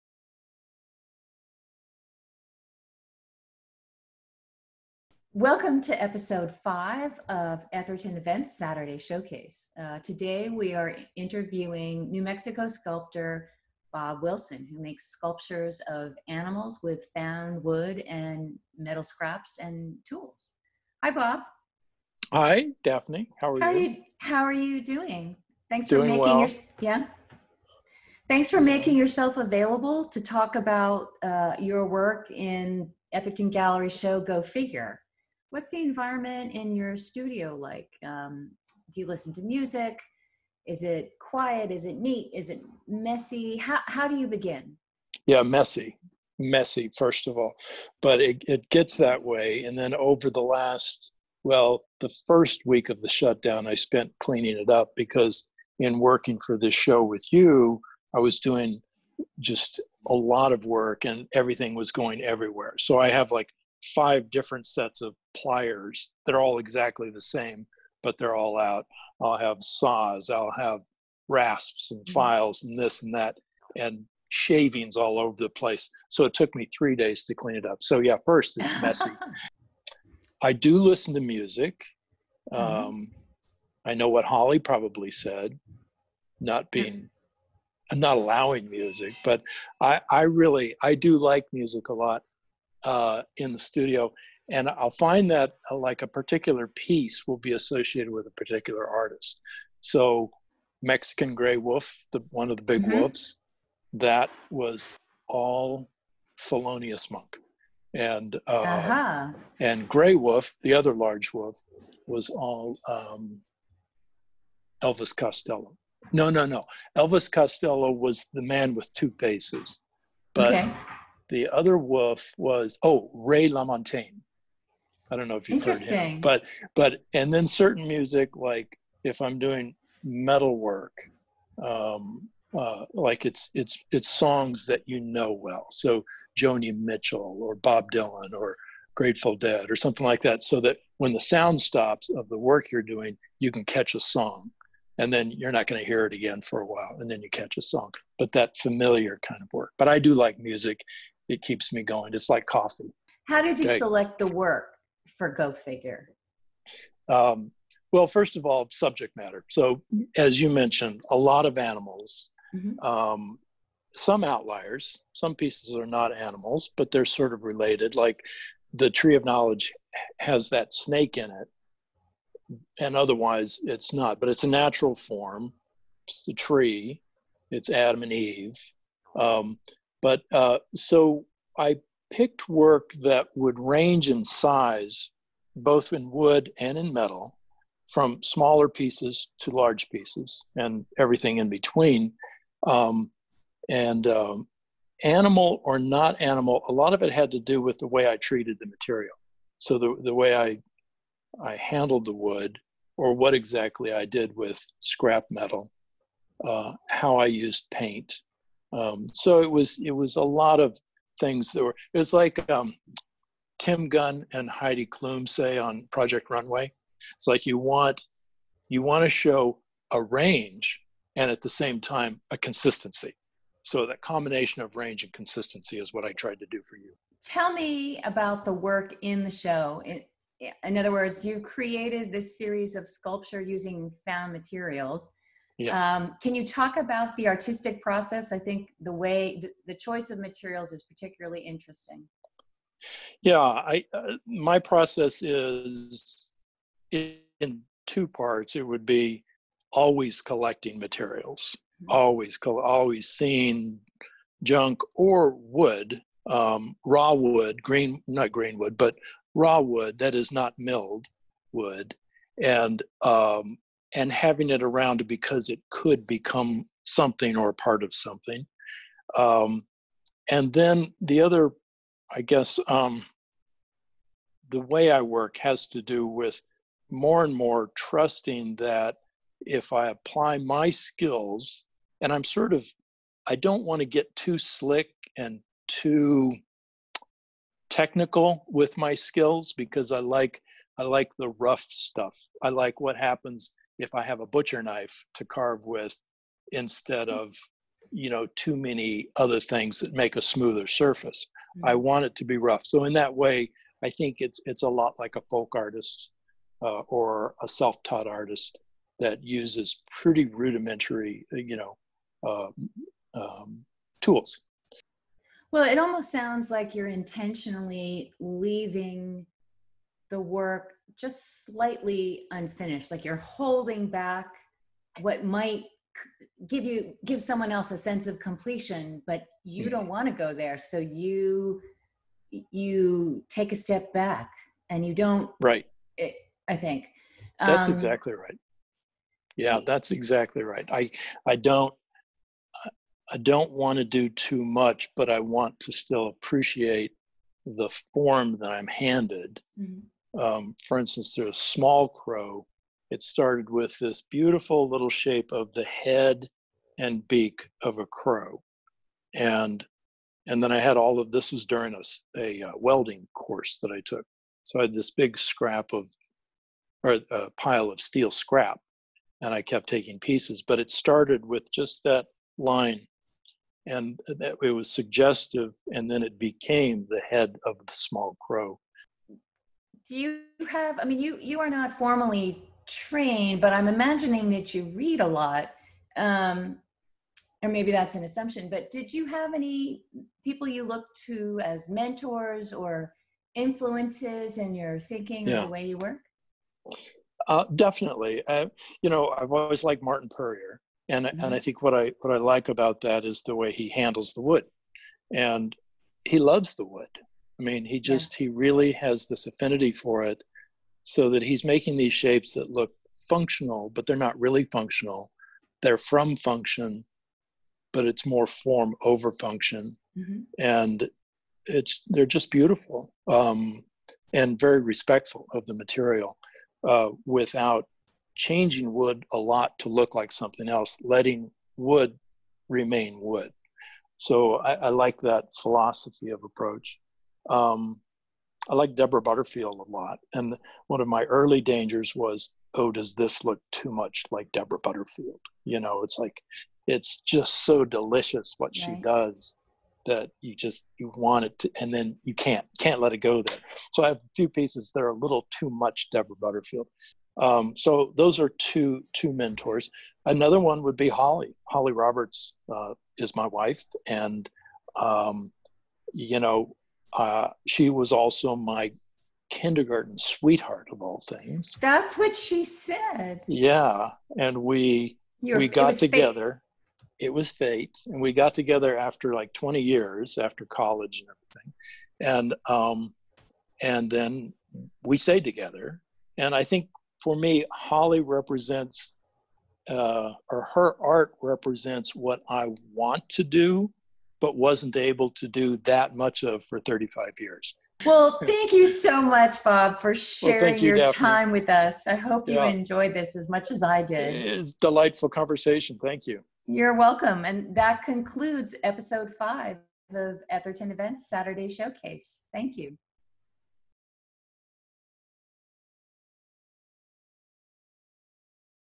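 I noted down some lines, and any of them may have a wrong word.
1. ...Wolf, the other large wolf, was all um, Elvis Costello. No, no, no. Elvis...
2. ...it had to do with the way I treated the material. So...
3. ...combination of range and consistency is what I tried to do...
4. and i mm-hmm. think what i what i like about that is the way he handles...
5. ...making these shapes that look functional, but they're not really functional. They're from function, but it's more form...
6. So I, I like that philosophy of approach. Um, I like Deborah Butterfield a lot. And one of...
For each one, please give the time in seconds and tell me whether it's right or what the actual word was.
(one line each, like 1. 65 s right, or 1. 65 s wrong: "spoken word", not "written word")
1. 110 s right
2. 197 s right
3. 224 s right
4. 401 s right
5. 411 s right
6. 433 s right.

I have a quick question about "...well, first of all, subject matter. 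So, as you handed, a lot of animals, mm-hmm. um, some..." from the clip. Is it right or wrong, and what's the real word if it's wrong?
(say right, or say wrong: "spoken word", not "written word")
wrong: "mentioned", not "handed".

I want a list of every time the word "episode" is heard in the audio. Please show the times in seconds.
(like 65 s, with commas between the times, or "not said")
6 s, 508 s.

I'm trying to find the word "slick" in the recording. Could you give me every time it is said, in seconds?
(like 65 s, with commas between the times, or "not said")
284 s.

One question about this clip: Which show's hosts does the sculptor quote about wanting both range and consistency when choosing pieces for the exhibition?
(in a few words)
Project Runway.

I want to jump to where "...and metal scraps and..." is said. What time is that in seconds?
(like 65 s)
18 s.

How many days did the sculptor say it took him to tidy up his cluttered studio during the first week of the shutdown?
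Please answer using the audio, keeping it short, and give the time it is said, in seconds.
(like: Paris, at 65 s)
3, at 76 s.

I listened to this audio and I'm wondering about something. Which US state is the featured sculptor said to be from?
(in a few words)
New Mexico.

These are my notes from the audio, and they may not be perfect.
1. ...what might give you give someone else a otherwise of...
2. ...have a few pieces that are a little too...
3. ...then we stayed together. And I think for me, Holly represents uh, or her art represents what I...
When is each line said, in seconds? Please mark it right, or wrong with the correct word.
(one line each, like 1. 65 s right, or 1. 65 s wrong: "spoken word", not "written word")
1. 325 s wrong: "sense", not "otherwise"
2. 453 s right
3. 483 s right.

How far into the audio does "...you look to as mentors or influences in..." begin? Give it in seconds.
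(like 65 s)
390 s.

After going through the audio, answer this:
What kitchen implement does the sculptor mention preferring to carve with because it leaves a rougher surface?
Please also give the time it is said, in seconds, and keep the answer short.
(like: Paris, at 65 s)
Butcher knife, at 294 s.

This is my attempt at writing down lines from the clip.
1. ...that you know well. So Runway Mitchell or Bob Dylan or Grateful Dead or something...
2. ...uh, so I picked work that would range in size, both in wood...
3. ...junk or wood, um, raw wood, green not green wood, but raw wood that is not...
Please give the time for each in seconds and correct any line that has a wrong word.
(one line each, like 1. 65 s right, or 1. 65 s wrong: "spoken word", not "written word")
1. 134 s wrong: "Joni", not "Runway"
2. 180 s right
3. 254 s right.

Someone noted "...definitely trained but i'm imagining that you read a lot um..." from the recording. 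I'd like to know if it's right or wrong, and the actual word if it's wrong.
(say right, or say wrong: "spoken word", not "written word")
wrong: "formally", not "definitely".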